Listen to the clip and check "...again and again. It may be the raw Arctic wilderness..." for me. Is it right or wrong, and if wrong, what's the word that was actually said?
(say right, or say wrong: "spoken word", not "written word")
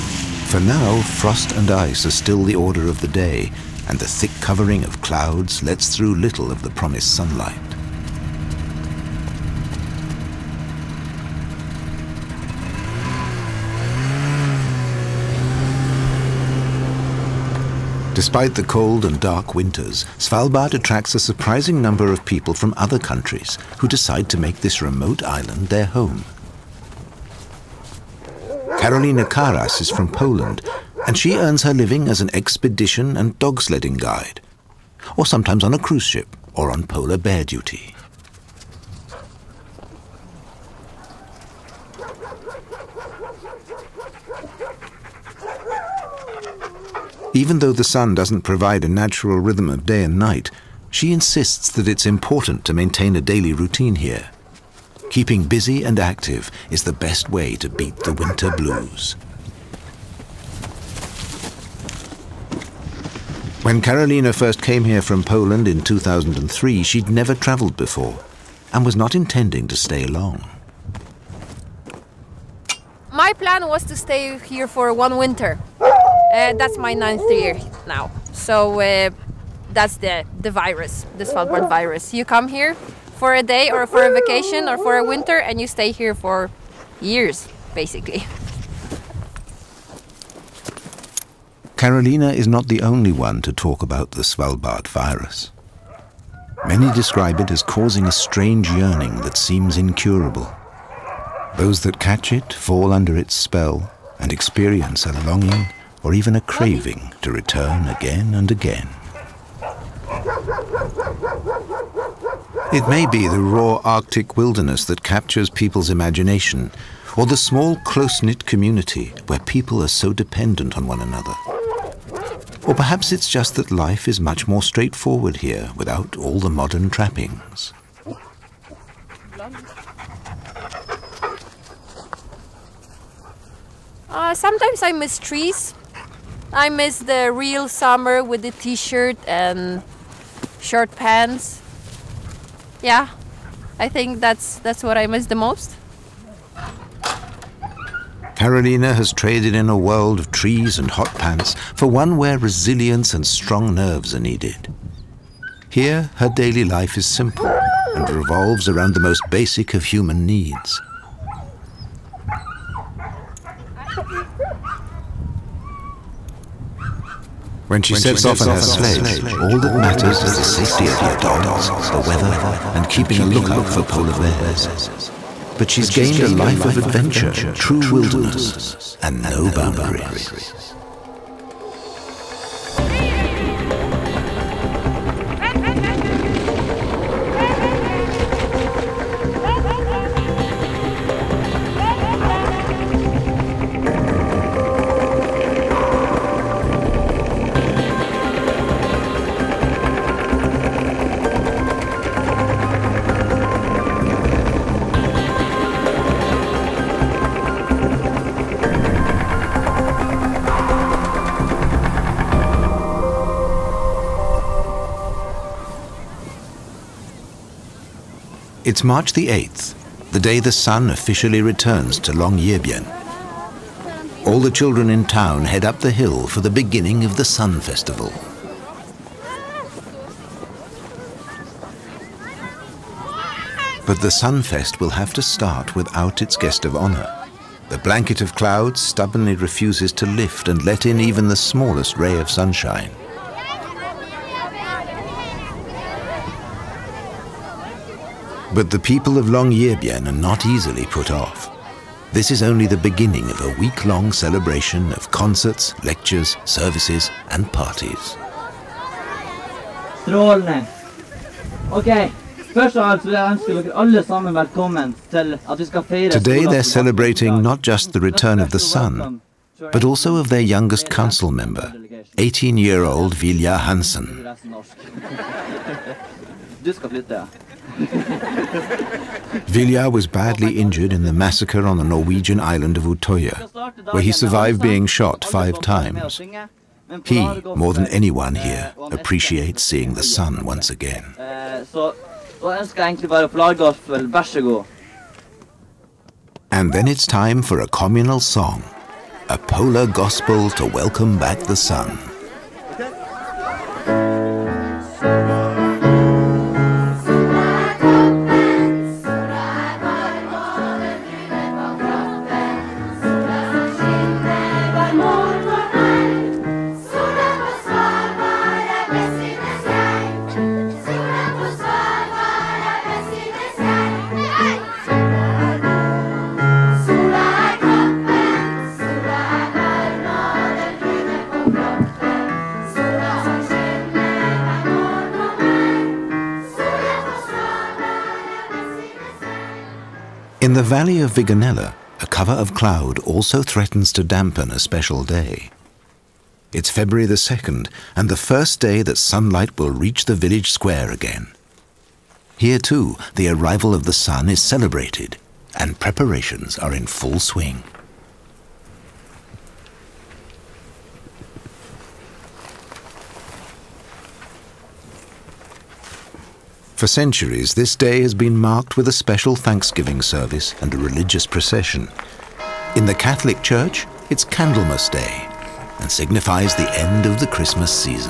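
right.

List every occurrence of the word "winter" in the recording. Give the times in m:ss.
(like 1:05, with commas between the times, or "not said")
0:19, 0:58, 1:15, 1:25.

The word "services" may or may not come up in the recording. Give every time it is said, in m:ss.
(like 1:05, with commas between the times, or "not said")
4:16, 6:09.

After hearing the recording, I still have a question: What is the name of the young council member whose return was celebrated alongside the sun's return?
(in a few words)
Viljar Hansen.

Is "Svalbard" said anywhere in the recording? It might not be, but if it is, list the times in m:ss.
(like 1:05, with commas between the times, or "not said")
0:20, 1:21, 1:34.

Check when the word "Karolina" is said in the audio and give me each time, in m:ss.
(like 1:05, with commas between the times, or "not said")
0:28, 1:03, 1:31, 2:28.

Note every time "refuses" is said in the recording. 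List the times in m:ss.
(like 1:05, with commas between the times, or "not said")
3:59.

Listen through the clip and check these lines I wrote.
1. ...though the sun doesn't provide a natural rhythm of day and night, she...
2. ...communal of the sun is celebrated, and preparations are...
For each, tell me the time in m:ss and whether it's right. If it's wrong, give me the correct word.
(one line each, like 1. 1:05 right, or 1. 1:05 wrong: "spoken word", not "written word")
1. 0:47 right
2. 5:53 wrong: "arrival", not "communal".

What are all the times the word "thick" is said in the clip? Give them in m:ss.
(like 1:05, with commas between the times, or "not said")
0:04.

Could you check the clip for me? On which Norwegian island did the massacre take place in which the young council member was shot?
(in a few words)
Utoya.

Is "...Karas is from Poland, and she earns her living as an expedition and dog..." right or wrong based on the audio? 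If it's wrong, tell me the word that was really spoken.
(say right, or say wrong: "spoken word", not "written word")
right.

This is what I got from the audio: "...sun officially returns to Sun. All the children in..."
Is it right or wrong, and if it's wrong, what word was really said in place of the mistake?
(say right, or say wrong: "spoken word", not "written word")
wrong: "Longyearbyen", not "Sun".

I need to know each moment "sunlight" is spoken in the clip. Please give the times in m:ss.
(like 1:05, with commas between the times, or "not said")
0:07, 5:48.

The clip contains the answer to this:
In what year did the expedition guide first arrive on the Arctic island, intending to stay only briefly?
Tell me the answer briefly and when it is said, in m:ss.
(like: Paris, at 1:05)
2003, at 1:05.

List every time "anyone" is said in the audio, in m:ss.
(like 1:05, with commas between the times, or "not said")
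4:47.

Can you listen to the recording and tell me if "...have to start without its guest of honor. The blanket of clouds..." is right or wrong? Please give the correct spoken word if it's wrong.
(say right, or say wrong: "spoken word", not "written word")
right.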